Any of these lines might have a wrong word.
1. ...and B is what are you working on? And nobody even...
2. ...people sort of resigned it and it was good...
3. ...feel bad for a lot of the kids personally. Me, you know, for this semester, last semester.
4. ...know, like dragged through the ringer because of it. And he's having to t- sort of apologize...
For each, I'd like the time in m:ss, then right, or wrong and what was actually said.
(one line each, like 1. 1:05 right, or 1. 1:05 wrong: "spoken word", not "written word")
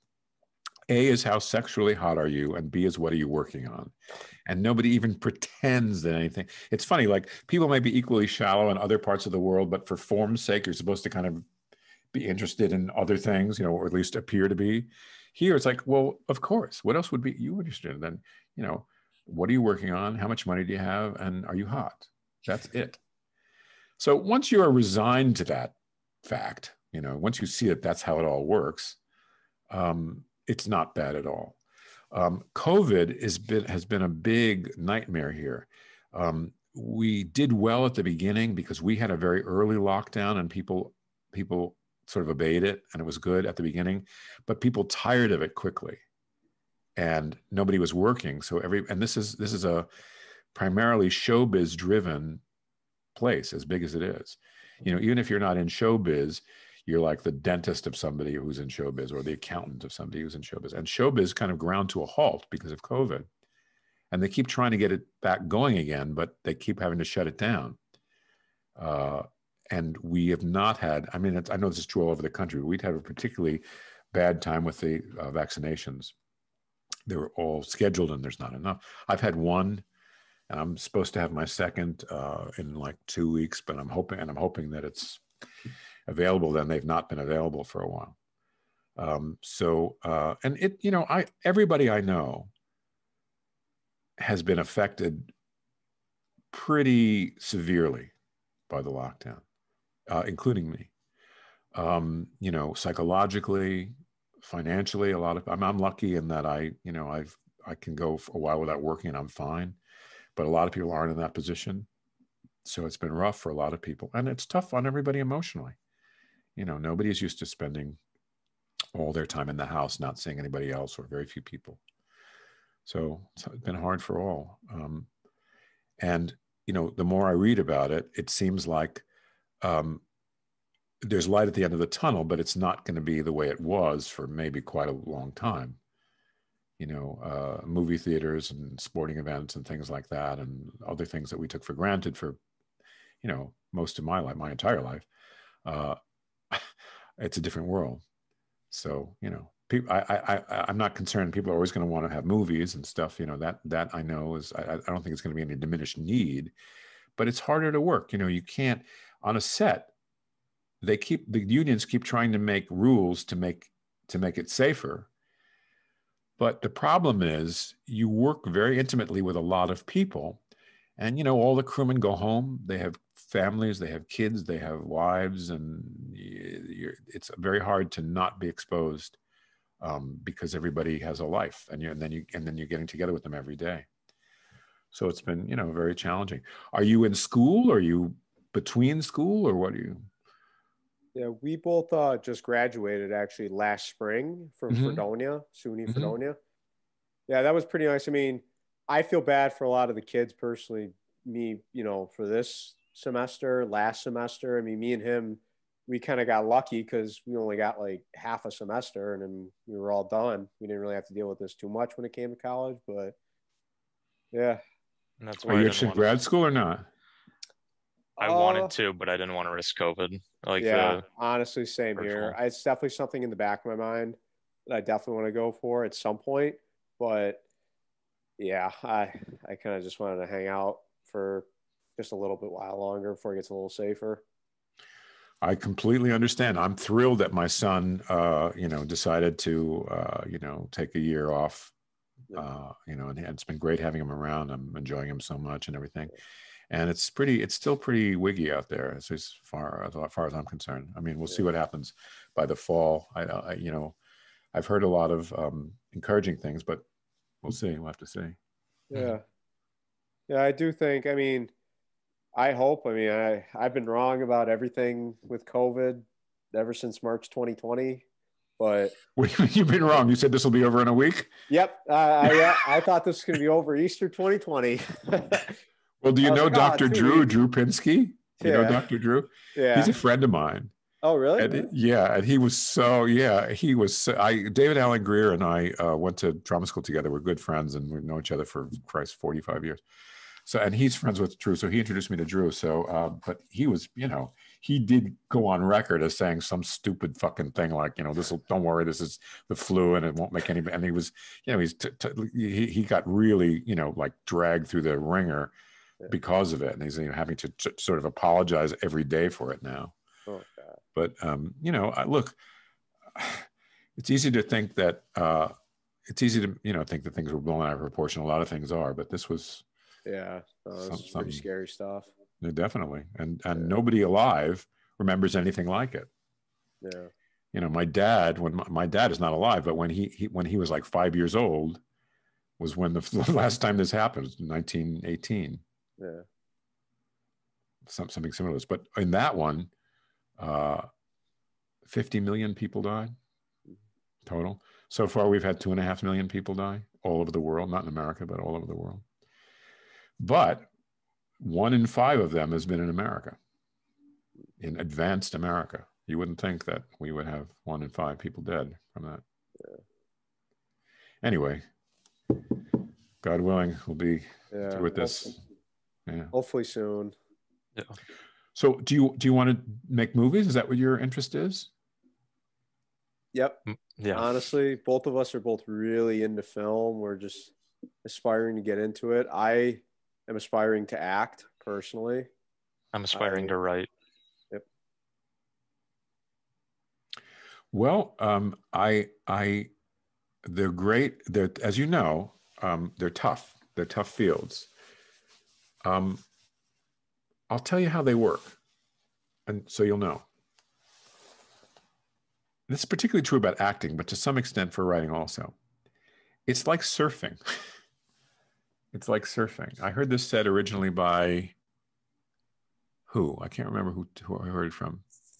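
1. 0:02 right
2. 0:41 wrong: "obeyed", not "resigned"
3. 3:19 right
4. 5:03 right.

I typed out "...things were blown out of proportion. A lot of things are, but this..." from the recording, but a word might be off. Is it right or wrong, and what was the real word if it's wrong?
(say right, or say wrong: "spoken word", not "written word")
right.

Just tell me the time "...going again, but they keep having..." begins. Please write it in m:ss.
1:05.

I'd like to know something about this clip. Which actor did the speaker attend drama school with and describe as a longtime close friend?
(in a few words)
David Alan Grier.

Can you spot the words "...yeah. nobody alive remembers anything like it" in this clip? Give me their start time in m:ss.
5:23.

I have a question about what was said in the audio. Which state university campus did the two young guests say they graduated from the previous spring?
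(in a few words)
Fredonia, SUNY.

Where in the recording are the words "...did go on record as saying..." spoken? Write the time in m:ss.
4:54.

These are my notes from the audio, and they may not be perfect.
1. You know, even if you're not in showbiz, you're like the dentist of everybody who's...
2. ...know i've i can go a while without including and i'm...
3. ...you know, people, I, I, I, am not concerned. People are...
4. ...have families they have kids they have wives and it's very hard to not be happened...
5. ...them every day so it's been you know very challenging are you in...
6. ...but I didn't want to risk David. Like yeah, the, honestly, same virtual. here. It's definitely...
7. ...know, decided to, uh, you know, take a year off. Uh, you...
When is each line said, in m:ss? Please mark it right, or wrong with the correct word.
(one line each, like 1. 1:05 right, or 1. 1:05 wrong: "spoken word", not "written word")
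1. 0:54 wrong: "somebody", not "everybody"
2. 1:46 wrong: "working", not "including"
3. 2:29 right
4. 2:52 wrong: "exposed", not "happened"
5. 3:03 right
6. 3:38 wrong: "COVID", not "David"
7. 3:58 right.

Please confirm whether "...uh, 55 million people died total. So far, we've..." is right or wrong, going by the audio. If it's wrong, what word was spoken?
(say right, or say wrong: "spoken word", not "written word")
wrong: "50", not "55".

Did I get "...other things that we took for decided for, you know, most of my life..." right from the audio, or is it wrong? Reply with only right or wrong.
wrong.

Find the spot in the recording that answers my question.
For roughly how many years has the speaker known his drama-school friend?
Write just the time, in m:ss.
4:49.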